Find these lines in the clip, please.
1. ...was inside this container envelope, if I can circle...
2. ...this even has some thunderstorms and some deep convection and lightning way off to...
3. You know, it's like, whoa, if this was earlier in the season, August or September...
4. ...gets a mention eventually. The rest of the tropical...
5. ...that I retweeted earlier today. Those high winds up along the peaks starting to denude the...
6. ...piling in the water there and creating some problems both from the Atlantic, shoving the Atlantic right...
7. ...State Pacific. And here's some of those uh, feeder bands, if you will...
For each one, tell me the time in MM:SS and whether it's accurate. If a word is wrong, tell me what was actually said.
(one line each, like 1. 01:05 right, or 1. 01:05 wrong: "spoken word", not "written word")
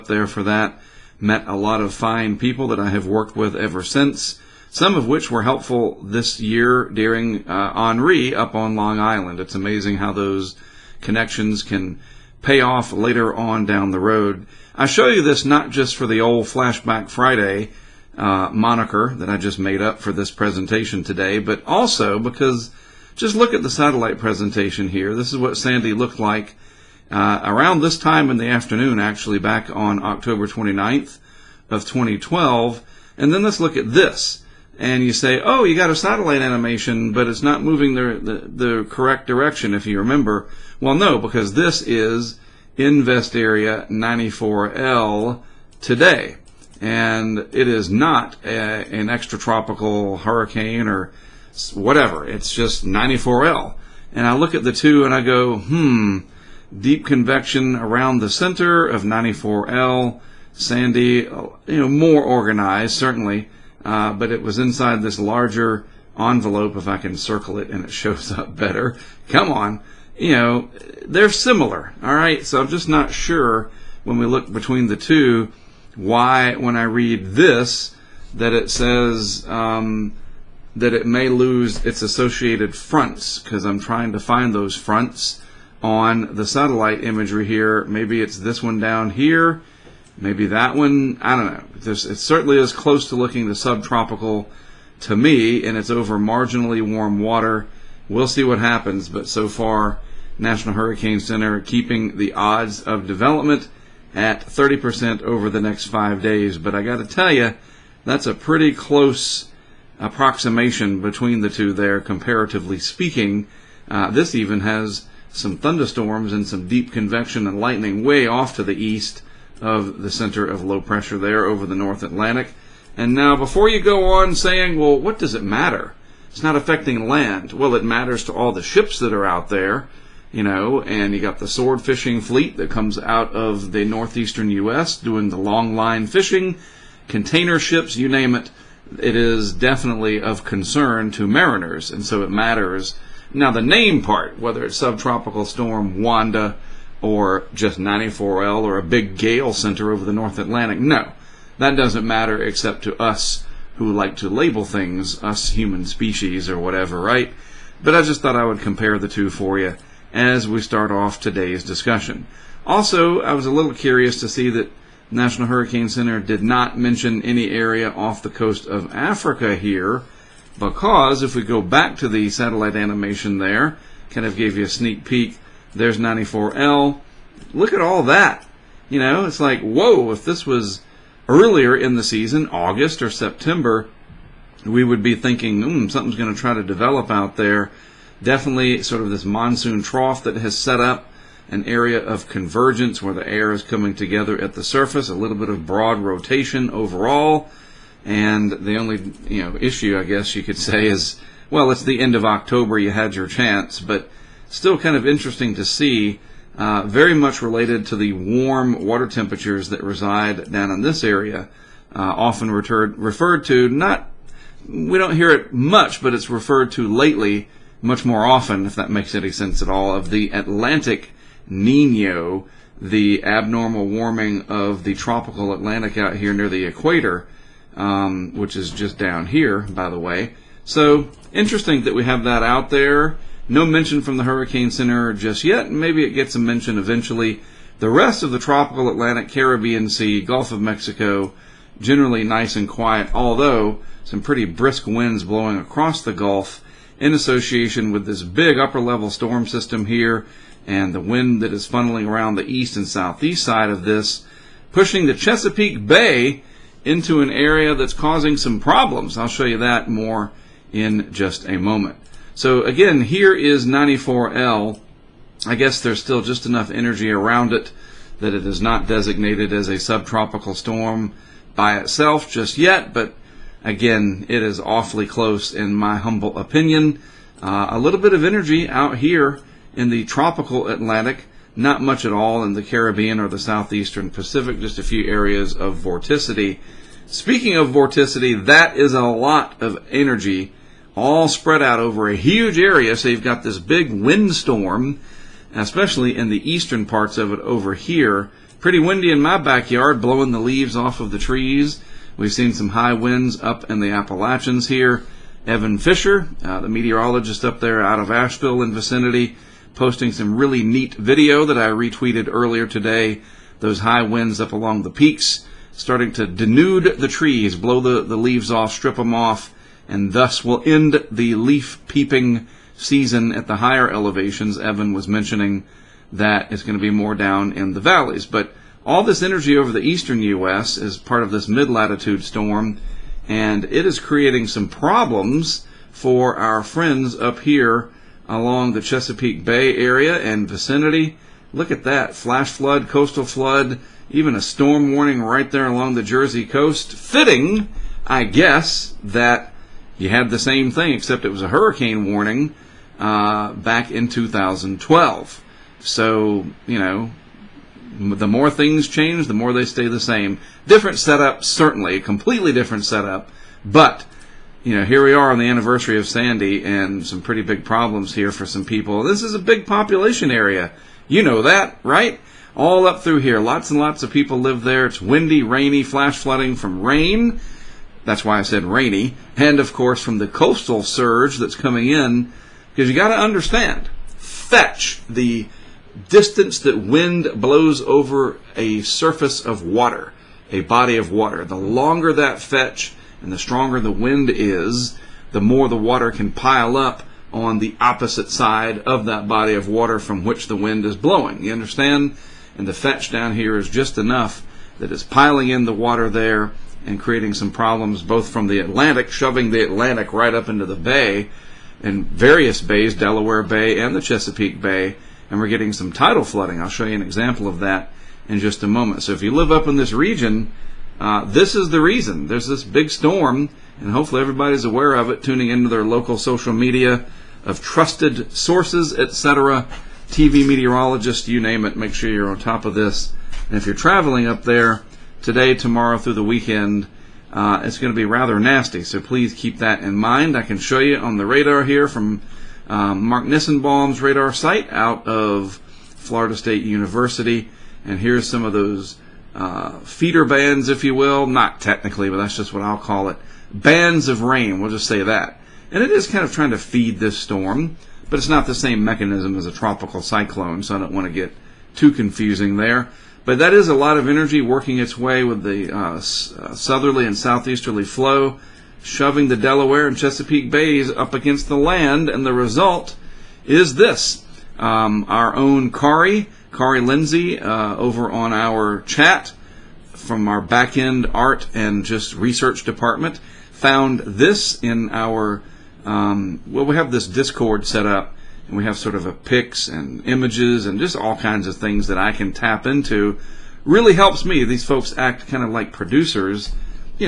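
1. 01:04 wrong: "larger", not "container"
2. 01:54 right
3. 02:58 right
4. 03:56 right
5. 05:11 right
6. 06:45 right
7. 07:26 wrong: "University", not "Pacific".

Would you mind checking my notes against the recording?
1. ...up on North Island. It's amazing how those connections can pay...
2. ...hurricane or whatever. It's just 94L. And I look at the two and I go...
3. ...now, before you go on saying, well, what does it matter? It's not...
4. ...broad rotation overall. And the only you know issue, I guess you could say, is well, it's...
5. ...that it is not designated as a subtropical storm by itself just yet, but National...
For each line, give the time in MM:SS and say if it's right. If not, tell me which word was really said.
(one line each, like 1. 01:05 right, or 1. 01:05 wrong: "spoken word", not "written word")
1. 00:08 wrong: "Long", not "North"
2. 00:50 right
3. 02:03 right
4. 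03:15 right
5. 04:28 wrong: "Again", not "National".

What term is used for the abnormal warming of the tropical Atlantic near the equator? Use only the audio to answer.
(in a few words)
Atlantic Nino.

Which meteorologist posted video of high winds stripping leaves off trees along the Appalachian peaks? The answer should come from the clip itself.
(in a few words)
Evan Fisher.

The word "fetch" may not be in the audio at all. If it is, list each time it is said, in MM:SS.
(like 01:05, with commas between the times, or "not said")
06:24, 06:32, 06:42.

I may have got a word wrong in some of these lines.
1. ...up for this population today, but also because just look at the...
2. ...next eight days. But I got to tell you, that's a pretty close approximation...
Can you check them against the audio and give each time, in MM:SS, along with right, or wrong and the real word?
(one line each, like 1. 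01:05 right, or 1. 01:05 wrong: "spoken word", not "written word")
1. 00:19 wrong: "presentation", not "population"
2. 01:45 wrong: "five", not "eight".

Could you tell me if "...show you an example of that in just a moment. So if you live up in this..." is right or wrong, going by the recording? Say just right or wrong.
right.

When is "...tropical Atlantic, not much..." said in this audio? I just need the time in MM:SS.
04:40.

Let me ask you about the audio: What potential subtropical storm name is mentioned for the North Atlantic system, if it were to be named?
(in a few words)
Wanda.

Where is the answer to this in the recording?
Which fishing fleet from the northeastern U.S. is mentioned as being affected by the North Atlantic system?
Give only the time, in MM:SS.
02:11.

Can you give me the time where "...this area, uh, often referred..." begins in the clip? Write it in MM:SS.
03:30.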